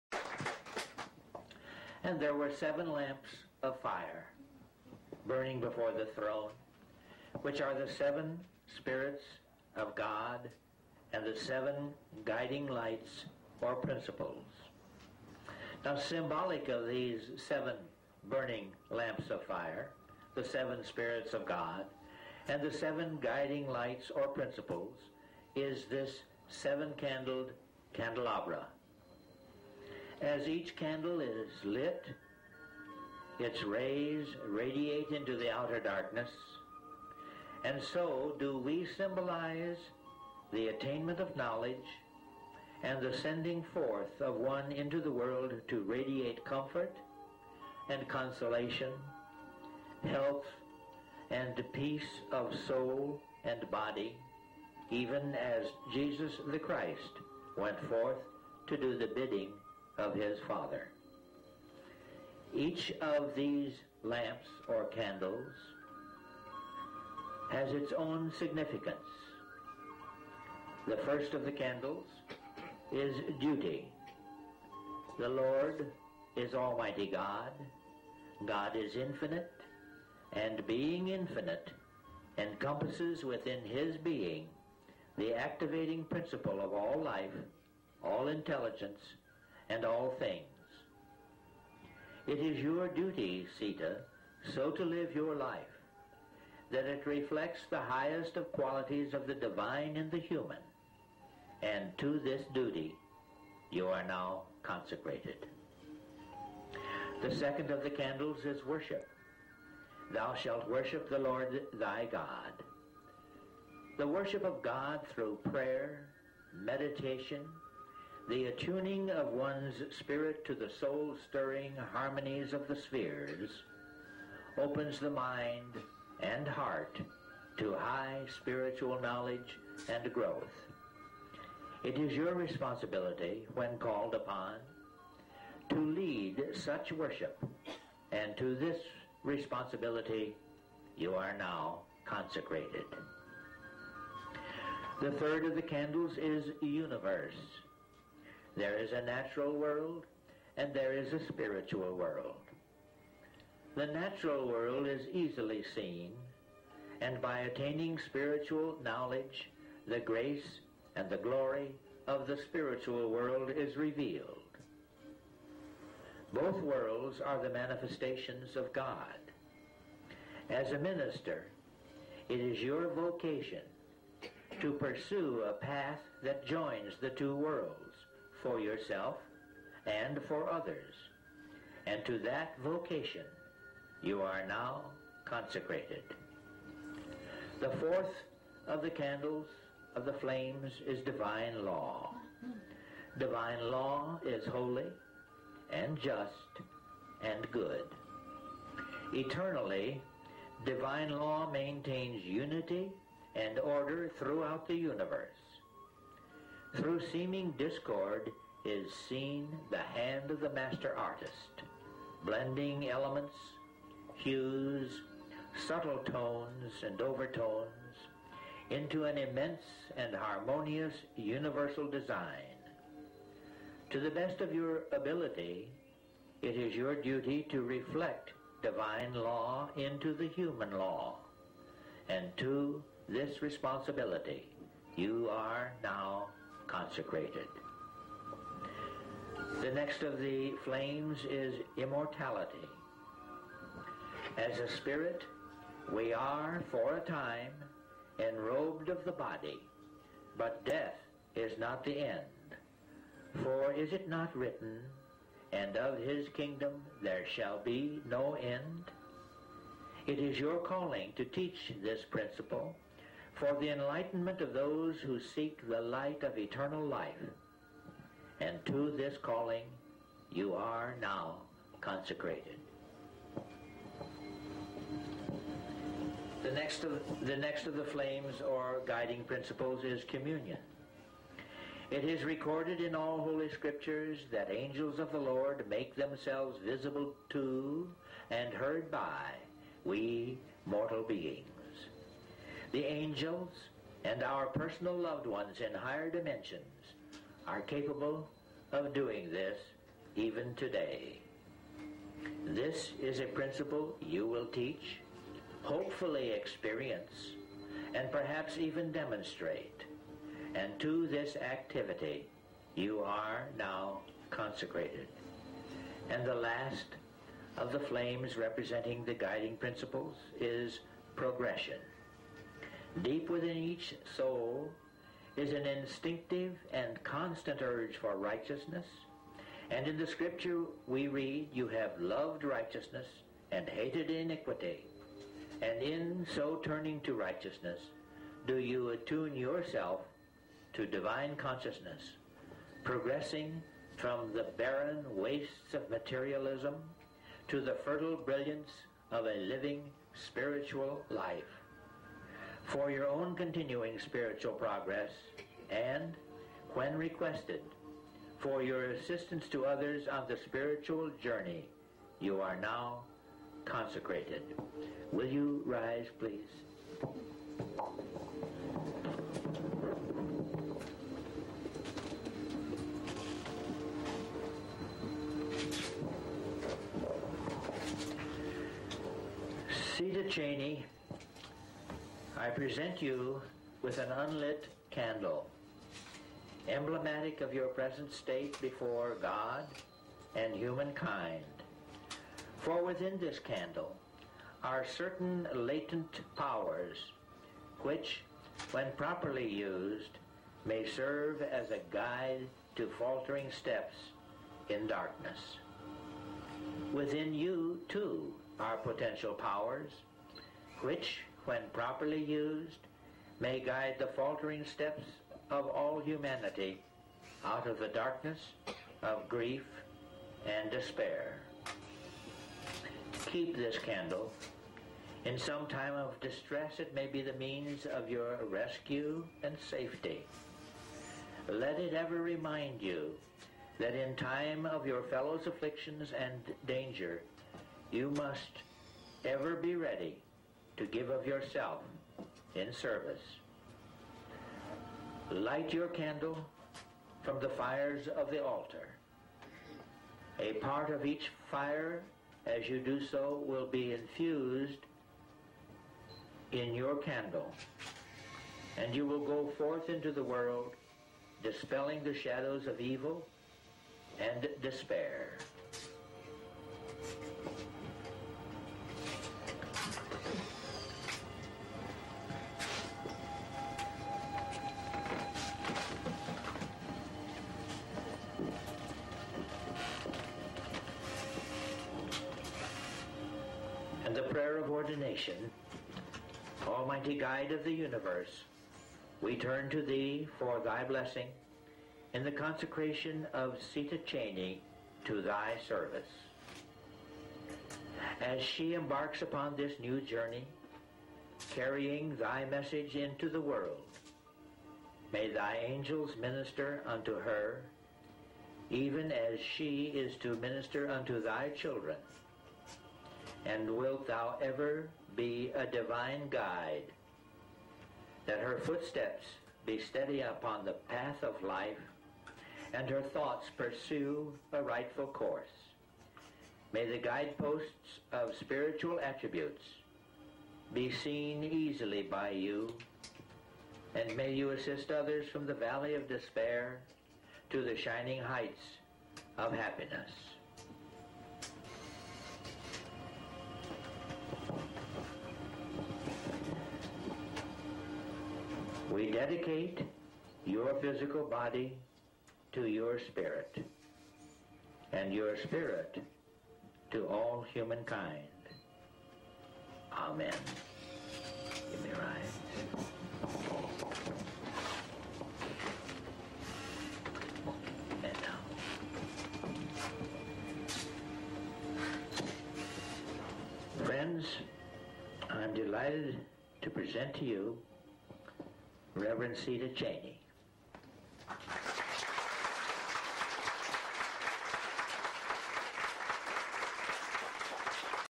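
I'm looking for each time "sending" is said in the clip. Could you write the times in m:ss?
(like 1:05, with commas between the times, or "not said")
0:43.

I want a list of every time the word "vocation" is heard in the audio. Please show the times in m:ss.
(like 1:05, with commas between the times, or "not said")
2:52, 3:02.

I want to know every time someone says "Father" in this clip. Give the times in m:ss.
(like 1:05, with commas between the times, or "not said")
1:00.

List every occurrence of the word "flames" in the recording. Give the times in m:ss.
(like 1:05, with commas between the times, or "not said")
3:10, 4:00, 4:37, 5:17.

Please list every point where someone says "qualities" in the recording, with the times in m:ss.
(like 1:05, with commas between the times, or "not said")
1:38.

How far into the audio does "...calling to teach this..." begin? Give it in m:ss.
4:20.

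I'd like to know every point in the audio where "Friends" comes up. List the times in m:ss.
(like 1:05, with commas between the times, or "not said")
9:33.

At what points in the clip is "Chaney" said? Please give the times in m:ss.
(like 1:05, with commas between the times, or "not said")
6:20, 8:14, 9:39.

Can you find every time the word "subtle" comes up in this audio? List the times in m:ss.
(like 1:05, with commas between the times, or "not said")
3:35.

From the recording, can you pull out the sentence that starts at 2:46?
Both worlds are the manifestations of God.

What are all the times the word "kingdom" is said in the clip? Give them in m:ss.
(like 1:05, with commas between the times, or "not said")
4:16.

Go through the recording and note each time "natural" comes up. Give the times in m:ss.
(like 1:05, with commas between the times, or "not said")
2:29, 2:33.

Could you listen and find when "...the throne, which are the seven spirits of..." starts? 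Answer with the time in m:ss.
0:05.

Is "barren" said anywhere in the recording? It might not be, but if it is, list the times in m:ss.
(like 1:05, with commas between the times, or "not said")
5:44.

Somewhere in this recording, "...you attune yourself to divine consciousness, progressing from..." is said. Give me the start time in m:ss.
5:38.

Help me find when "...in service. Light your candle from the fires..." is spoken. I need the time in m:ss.
7:22.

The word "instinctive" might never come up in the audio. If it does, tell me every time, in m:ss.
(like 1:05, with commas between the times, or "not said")
5:25.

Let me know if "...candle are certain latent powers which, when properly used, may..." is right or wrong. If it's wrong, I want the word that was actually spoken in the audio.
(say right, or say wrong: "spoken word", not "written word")
right.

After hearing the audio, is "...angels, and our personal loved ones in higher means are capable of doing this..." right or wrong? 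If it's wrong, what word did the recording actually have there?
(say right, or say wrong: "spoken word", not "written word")
wrong: "dimensions", not "means".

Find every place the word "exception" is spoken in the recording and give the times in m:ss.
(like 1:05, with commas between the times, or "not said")
not said.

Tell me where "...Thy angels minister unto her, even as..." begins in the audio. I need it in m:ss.
8:25.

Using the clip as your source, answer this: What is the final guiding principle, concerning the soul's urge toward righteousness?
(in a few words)
Progression.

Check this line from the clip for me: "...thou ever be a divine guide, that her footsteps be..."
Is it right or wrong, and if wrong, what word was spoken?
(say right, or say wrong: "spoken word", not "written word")
right.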